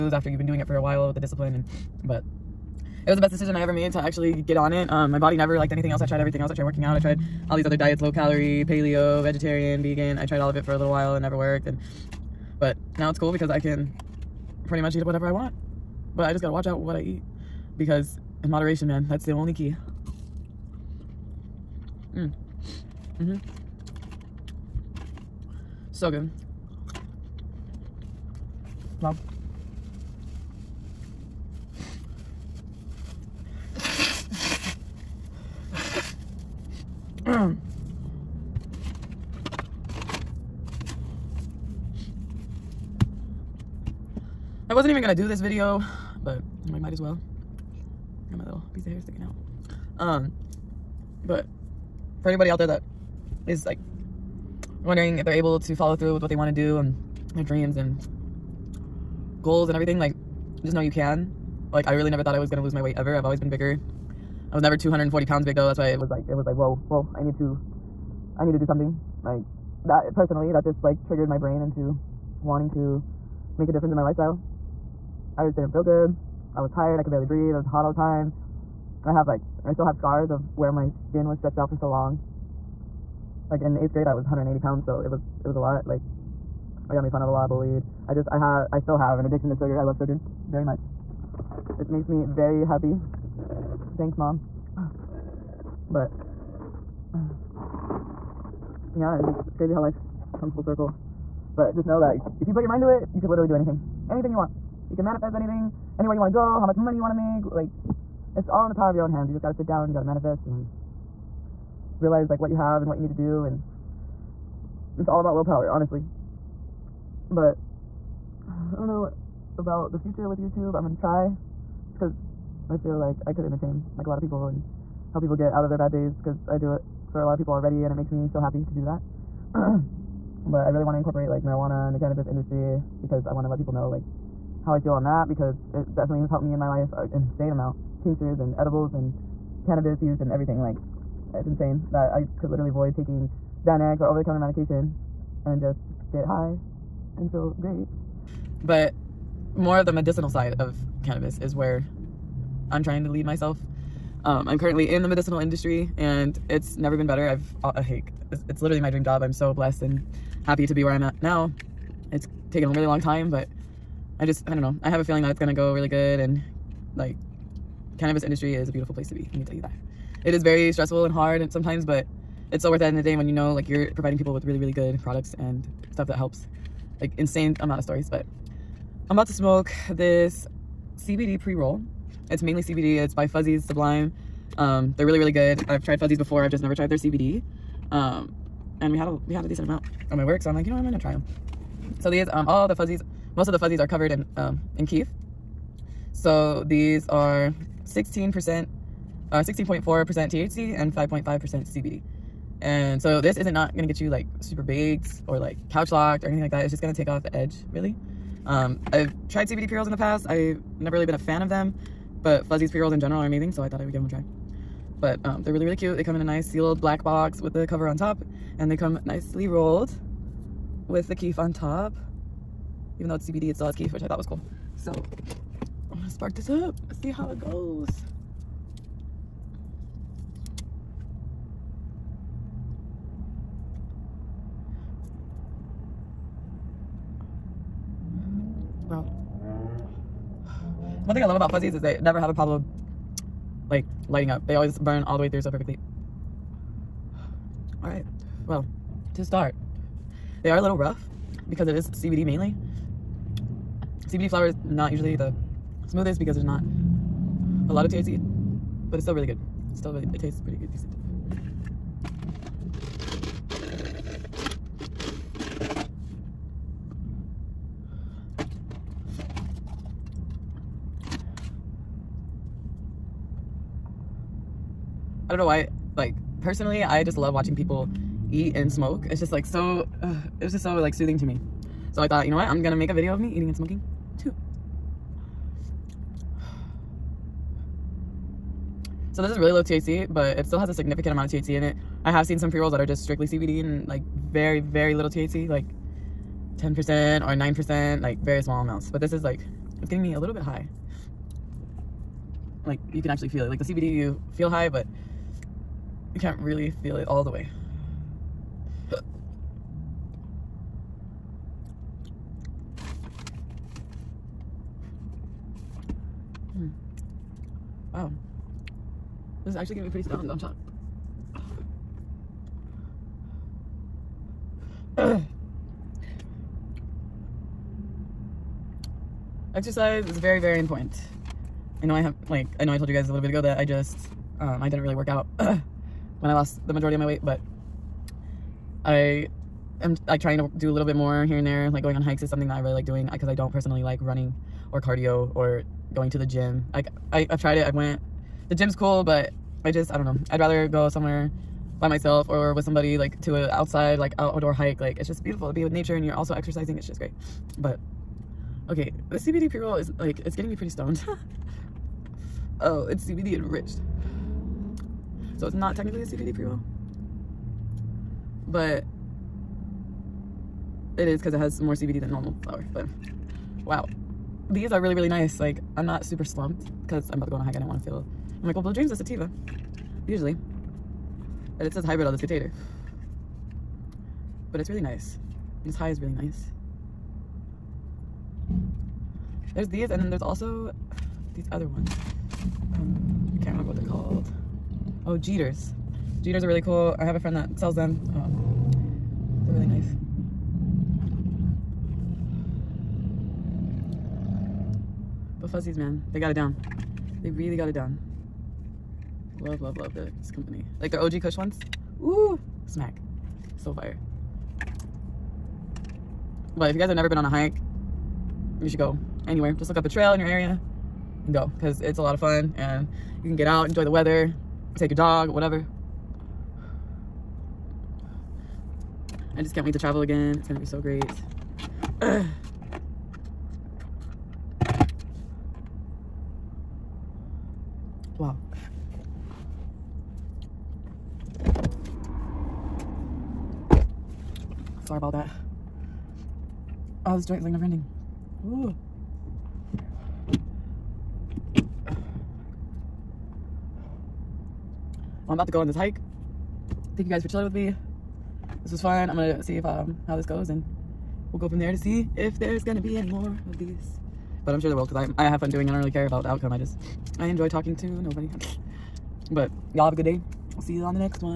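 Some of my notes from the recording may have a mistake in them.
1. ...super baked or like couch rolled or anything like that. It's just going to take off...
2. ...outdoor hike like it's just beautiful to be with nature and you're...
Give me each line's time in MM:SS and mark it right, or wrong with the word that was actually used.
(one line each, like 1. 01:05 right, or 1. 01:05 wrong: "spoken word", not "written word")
1. 03:24 wrong: "locked", not "rolled"
2. 05:54 right.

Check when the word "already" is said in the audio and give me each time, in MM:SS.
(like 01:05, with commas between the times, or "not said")
02:07.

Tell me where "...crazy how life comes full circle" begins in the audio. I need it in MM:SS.
01:39.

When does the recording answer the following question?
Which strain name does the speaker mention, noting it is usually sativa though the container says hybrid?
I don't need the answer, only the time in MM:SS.
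06:18.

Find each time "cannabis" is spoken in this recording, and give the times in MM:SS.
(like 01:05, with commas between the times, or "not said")
02:11, 02:19, 02:31, 02:47.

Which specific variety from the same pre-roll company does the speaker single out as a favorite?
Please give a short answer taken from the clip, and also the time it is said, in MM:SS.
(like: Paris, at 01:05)
OG Kush, at 06:50.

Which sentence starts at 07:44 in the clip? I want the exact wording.
But I'm sure there will because I, I have fun doing it.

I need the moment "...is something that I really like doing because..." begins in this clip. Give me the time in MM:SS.
05:42.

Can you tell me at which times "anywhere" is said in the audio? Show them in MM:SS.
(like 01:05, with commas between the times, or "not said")
01:45, 06:59.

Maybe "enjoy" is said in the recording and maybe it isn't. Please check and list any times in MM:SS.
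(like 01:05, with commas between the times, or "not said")
07:03, 07:47.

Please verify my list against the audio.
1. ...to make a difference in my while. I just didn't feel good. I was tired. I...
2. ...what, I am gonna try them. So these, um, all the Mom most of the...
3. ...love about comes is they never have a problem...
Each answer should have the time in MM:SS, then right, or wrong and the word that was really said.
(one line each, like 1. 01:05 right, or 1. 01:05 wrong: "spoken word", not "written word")
1. 01:12 wrong: "lifestyle", not "while"
2. 03:10 wrong: "Fuzzies", not "Mom"
3. 04:01 wrong: "fuzzies", not "comes".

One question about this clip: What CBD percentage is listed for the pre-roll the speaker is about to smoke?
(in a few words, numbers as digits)
5.5%.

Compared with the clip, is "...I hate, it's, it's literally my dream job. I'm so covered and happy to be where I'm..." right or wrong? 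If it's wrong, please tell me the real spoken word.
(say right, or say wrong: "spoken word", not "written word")
wrong: "blessed", not "covered".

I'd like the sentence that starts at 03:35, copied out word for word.
But um, they're really, really cute.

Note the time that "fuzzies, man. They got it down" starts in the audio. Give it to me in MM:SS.
06:45.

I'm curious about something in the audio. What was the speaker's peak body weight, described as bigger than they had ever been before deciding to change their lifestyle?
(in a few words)
240 pounds.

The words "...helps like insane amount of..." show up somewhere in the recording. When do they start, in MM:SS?
02:56.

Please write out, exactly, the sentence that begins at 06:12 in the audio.
But wow, these are really, really nice.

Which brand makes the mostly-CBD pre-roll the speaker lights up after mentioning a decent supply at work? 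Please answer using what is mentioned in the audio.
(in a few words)
Fuzzies Sublime.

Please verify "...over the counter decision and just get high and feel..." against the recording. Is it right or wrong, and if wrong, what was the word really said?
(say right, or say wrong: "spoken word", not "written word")
wrong: "medication", not "decision".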